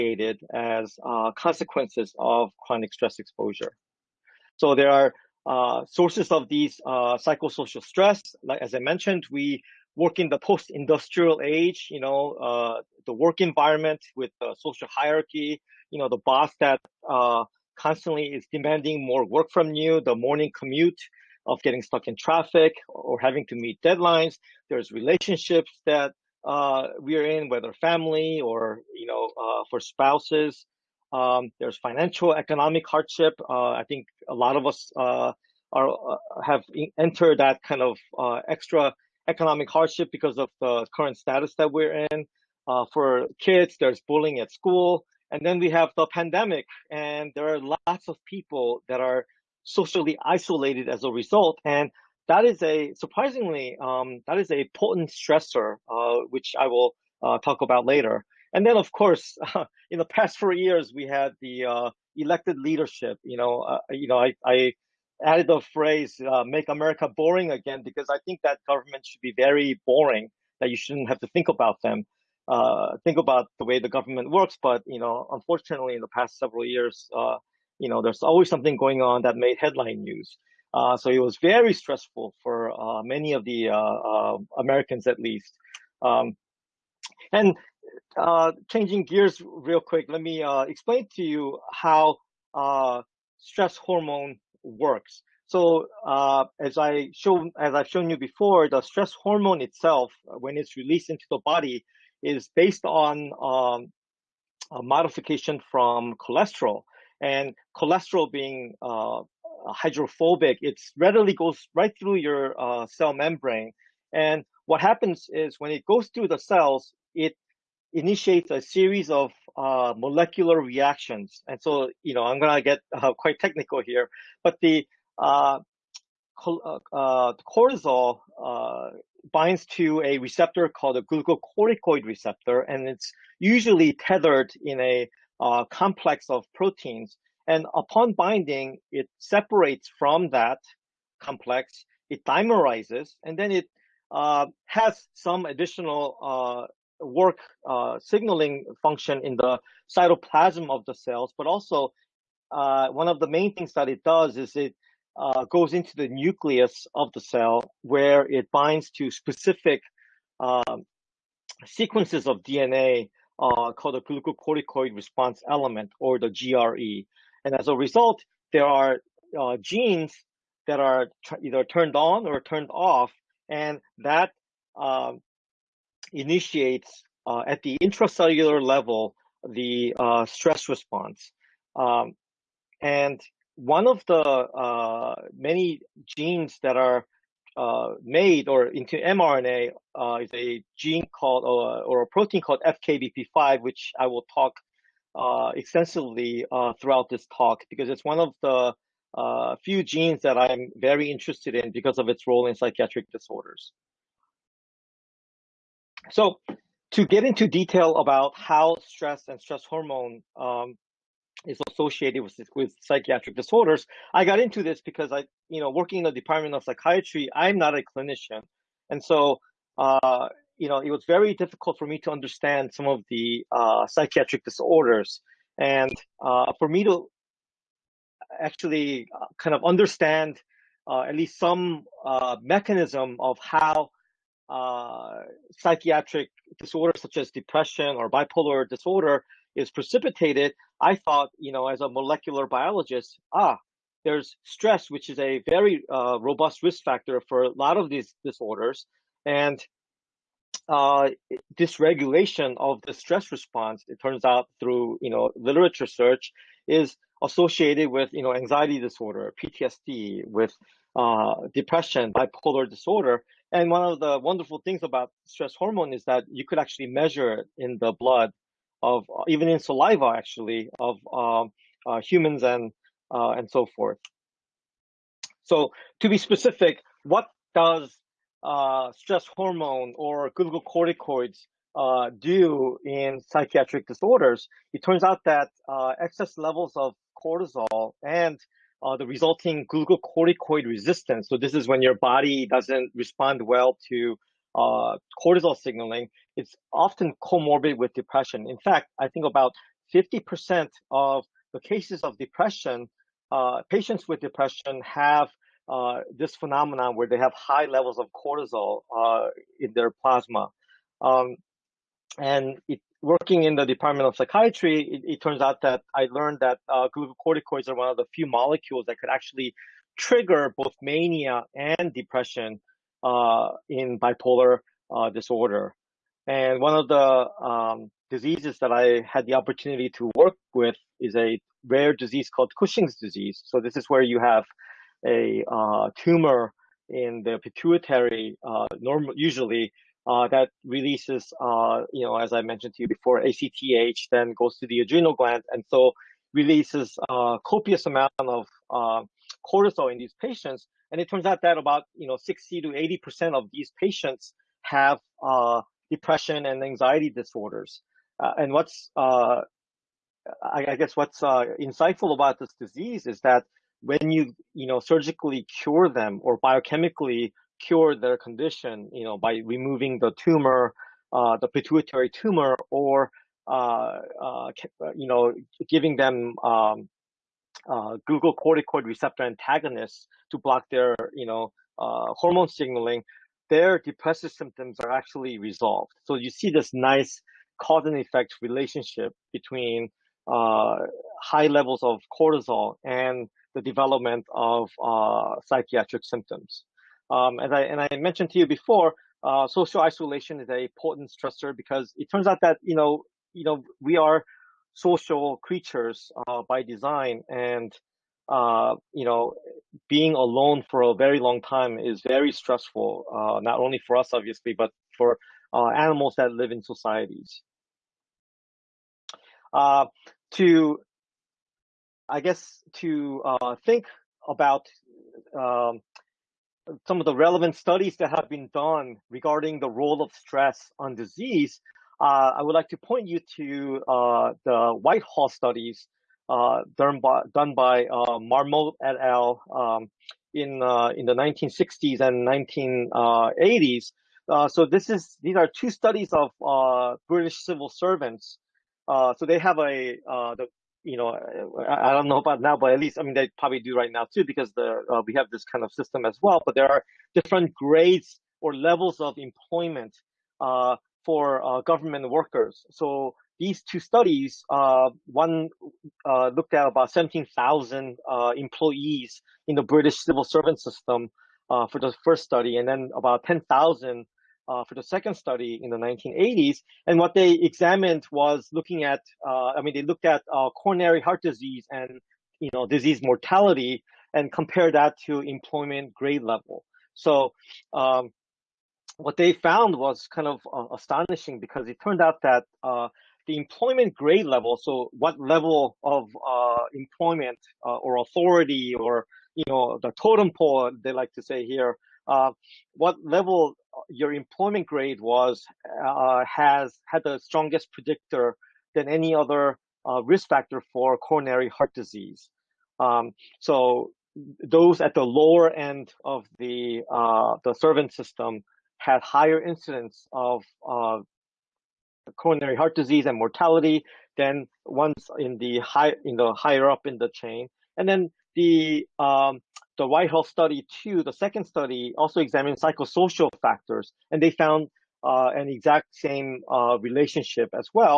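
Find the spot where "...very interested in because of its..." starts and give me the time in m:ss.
3:20.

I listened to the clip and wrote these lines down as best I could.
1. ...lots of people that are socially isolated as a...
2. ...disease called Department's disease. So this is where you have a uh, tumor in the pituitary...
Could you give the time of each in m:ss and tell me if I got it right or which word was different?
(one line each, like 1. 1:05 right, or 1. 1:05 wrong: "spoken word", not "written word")
1. 0:47 right
2. 5:31 wrong: "Cushing", not "Department".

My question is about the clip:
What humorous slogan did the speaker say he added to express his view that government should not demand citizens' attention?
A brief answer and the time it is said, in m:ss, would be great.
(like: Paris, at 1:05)
Make America Boring Again, at 1:06.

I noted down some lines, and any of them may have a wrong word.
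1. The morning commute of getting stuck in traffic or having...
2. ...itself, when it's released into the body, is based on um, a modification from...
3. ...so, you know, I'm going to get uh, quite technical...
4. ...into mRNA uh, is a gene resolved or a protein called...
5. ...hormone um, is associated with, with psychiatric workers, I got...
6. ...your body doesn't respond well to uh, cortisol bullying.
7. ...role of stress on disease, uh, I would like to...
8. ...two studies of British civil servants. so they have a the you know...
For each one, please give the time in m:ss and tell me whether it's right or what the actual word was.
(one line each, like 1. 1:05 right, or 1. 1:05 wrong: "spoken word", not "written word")
1. 0:20 right
2. 1:39 right
3. 2:01 right
4. 3:08 wrong: "called", not "resolved"
5. 3:29 wrong: "disorders", not "workers"
6. 4:51 wrong: "signaling", not "bullying"
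7. 7:09 right
8. 7:25 right.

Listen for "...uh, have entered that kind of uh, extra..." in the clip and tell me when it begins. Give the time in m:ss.
0:35.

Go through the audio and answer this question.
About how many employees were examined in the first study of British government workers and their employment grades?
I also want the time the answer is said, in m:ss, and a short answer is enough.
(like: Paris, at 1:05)
17,000, at 7:46.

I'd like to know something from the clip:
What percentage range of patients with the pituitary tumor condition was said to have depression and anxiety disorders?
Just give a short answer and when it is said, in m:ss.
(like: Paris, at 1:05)
60 to 80 percent, at 5:52.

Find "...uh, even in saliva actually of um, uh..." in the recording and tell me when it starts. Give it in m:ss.
4:29.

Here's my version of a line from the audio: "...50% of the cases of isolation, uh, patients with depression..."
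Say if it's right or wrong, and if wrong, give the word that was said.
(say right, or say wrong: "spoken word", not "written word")
wrong: "depression", not "isolation".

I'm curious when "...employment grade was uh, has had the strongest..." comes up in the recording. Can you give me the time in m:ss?
8:24.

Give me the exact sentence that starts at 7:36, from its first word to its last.
But there are different grades or levels of employment uh, for uh, government workers.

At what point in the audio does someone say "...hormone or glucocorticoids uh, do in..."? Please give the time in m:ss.
4:39.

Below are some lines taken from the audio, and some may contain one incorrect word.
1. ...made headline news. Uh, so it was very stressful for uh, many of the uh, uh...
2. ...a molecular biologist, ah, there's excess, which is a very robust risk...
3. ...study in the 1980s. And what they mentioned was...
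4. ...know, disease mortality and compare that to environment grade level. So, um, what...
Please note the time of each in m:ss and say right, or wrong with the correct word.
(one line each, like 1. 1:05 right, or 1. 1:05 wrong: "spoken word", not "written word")
1. 1:19 right
2. 4:01 wrong: "stress", not "excess"
3. 7:55 wrong: "examined", not "mentioned"
4. 8:02 wrong: "employment", not "environment".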